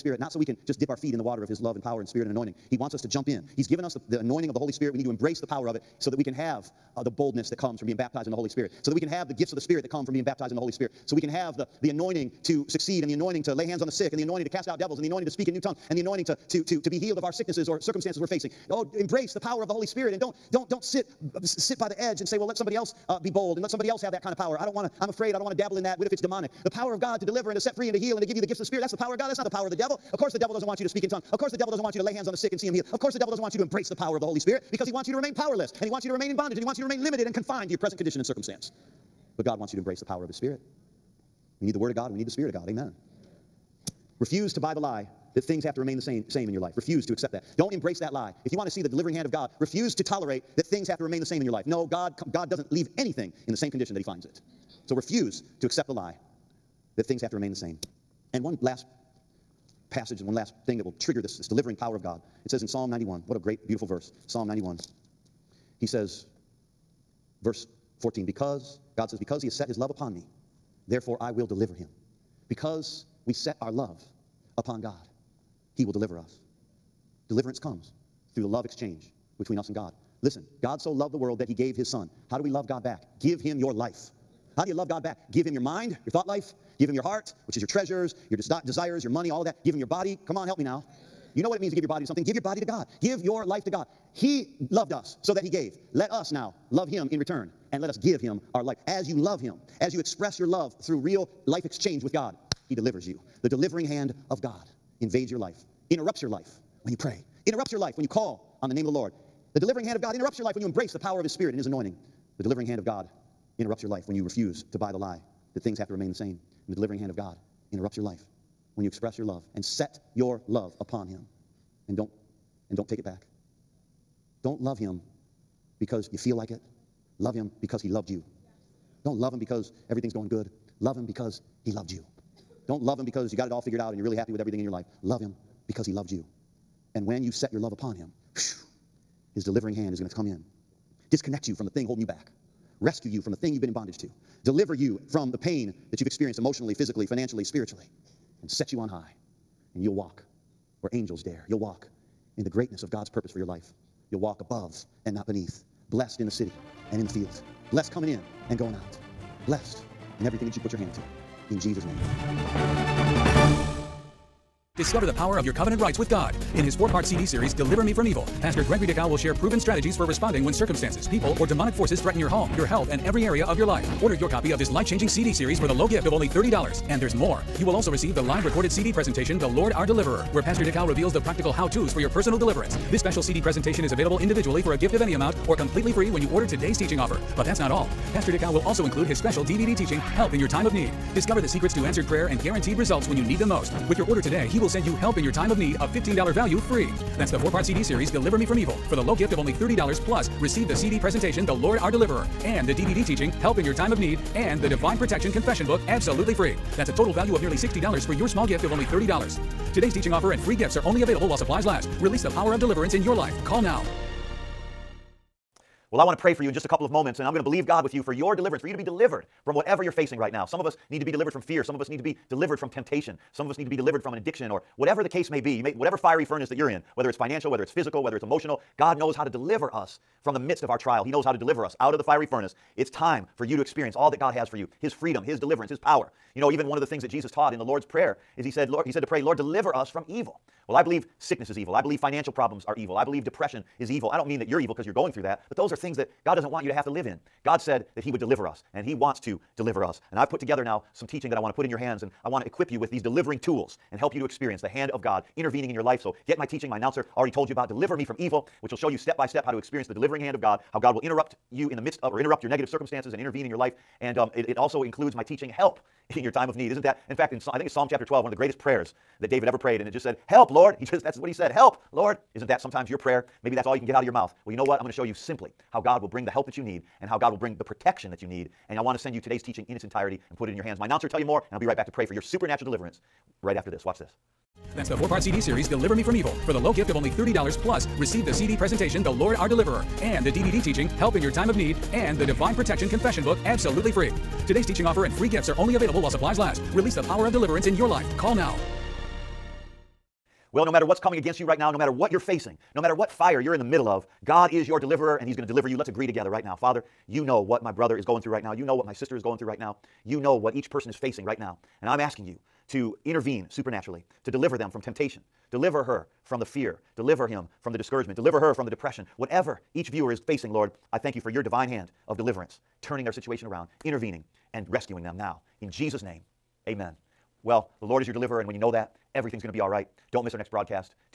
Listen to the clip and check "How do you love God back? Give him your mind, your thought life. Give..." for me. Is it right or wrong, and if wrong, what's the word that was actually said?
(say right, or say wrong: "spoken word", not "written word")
right.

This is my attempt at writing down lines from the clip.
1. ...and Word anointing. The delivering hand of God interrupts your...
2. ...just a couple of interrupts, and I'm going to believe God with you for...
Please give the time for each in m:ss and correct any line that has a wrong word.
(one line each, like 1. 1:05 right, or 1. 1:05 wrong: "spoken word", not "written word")
1. 1:51 wrong: "His", not "Word"
2. 3:36 wrong: "moments", not "interrupts".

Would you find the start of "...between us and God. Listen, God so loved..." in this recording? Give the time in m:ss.
1:19.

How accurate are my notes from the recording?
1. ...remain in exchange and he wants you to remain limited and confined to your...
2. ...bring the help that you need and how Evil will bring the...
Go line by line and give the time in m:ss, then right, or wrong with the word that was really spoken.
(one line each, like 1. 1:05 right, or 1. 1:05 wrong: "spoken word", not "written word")
1. 0:36 wrong: "bondage", not "exchange"
2. 4:36 wrong: "God", not "Evil".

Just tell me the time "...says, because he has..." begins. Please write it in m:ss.
1:09.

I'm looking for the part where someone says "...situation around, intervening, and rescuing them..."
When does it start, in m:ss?
5:23.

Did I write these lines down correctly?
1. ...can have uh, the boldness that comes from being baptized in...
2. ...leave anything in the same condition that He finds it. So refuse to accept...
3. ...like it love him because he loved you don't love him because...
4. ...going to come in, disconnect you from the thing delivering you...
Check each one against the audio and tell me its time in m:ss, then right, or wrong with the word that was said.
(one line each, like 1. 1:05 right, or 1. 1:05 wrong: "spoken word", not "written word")
1. 0:06 right
2. 0:52 right
3. 2:06 right
4. 2:19 wrong: "holding", not "delivering".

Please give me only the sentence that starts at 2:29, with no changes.
And you'll walk where angels dare.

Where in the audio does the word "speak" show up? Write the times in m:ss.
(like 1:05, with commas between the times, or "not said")
0:15, 0:30.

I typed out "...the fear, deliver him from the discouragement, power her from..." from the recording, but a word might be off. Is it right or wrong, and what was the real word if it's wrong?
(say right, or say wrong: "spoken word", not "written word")
wrong: "deliver", not "power".